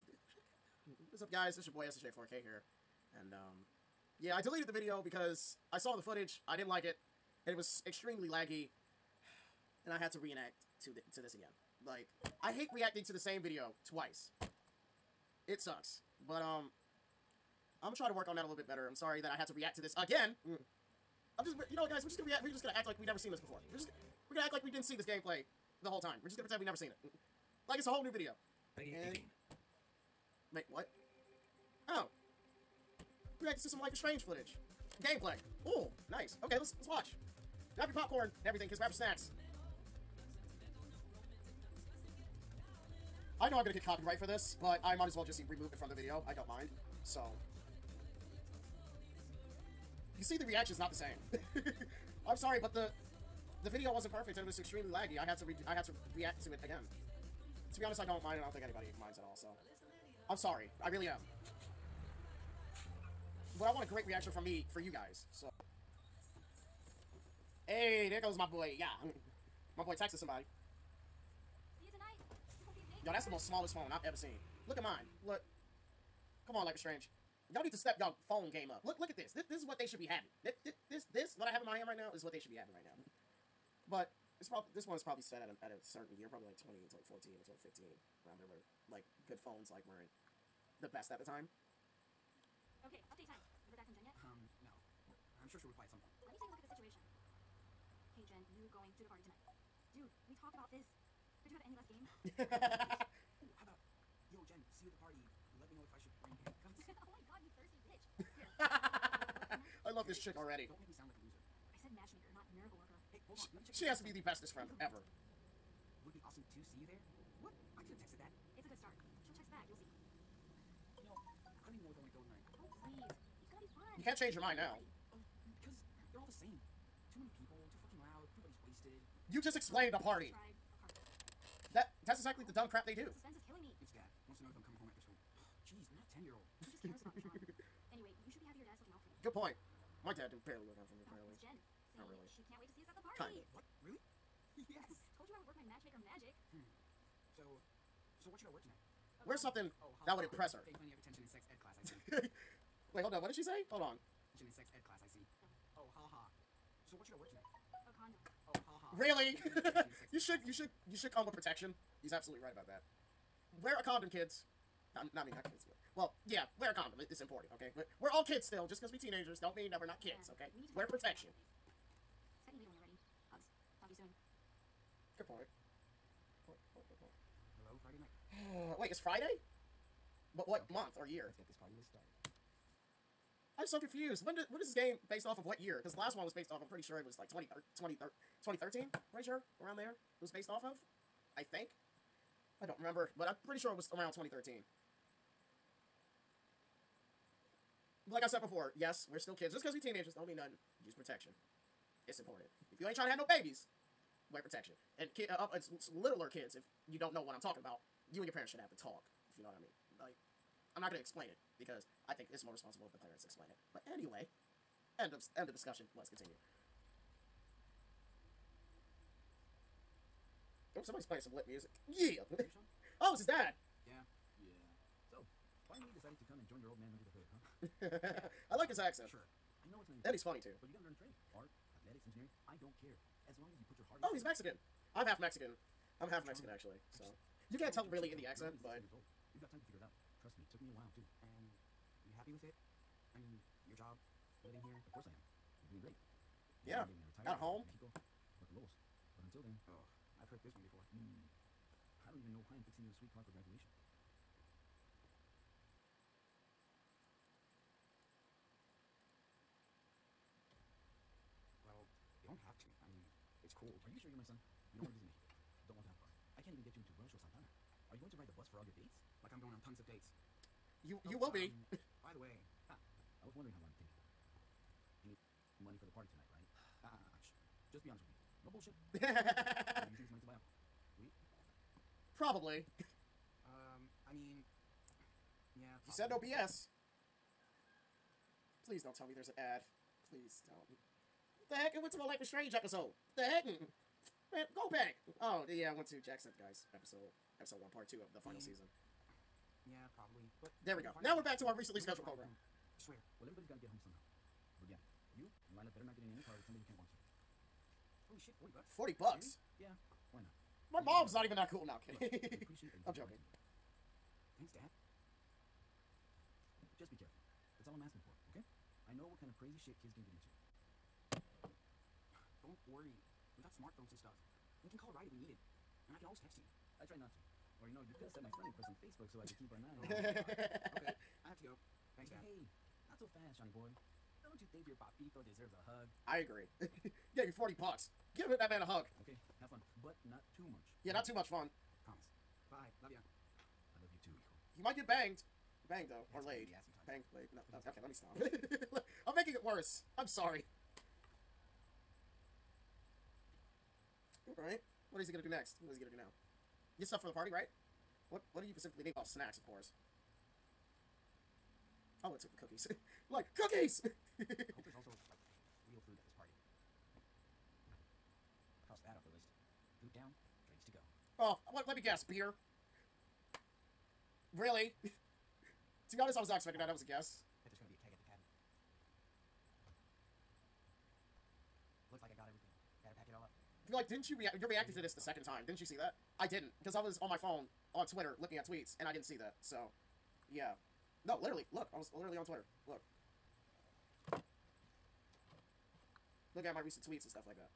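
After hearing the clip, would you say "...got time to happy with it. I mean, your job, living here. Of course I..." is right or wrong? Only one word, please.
right.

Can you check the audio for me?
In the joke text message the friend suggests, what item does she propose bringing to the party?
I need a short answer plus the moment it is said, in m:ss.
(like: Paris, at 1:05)
handcuffs, at 1:46.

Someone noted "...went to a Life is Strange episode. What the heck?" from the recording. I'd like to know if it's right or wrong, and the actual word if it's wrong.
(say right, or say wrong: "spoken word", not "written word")
right.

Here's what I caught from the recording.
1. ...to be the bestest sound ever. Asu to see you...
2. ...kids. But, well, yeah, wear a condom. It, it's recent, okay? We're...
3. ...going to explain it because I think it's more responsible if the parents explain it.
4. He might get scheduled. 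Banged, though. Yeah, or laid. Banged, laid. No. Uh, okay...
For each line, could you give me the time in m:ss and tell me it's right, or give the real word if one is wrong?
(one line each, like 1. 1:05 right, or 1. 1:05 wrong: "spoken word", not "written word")
1. 1:54 wrong: "friend", not "sound"
2. 2:45 wrong: "important", not "recent"
3. 3:30 right
4. 5:44 wrong: "banged", not "scheduled".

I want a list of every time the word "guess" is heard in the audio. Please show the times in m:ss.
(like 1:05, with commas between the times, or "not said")
6:11, 6:16.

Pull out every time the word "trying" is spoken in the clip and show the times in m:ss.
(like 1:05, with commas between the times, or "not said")
3:22, 3:56.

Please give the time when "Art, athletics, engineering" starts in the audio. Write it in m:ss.
3:51.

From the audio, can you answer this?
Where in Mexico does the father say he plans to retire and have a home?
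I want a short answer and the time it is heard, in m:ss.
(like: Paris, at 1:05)
Puerto Lobos, at 4:08.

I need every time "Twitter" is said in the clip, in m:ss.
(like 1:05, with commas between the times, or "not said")
6:27, 6:32.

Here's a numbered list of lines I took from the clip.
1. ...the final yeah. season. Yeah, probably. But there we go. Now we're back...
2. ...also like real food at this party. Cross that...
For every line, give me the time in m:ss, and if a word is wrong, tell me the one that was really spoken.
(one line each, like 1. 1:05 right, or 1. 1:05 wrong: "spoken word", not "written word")
1. 4:58 right
2. 6:04 right.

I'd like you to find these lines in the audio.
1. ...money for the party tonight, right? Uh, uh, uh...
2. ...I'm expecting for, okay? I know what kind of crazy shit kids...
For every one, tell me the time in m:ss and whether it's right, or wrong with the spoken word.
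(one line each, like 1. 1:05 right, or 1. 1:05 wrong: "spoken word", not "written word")
1. 4:35 right
2. 5:17 wrong: "asking", not "expecting".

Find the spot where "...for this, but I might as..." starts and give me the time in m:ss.
0:44.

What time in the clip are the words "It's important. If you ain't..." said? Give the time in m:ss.
3:22.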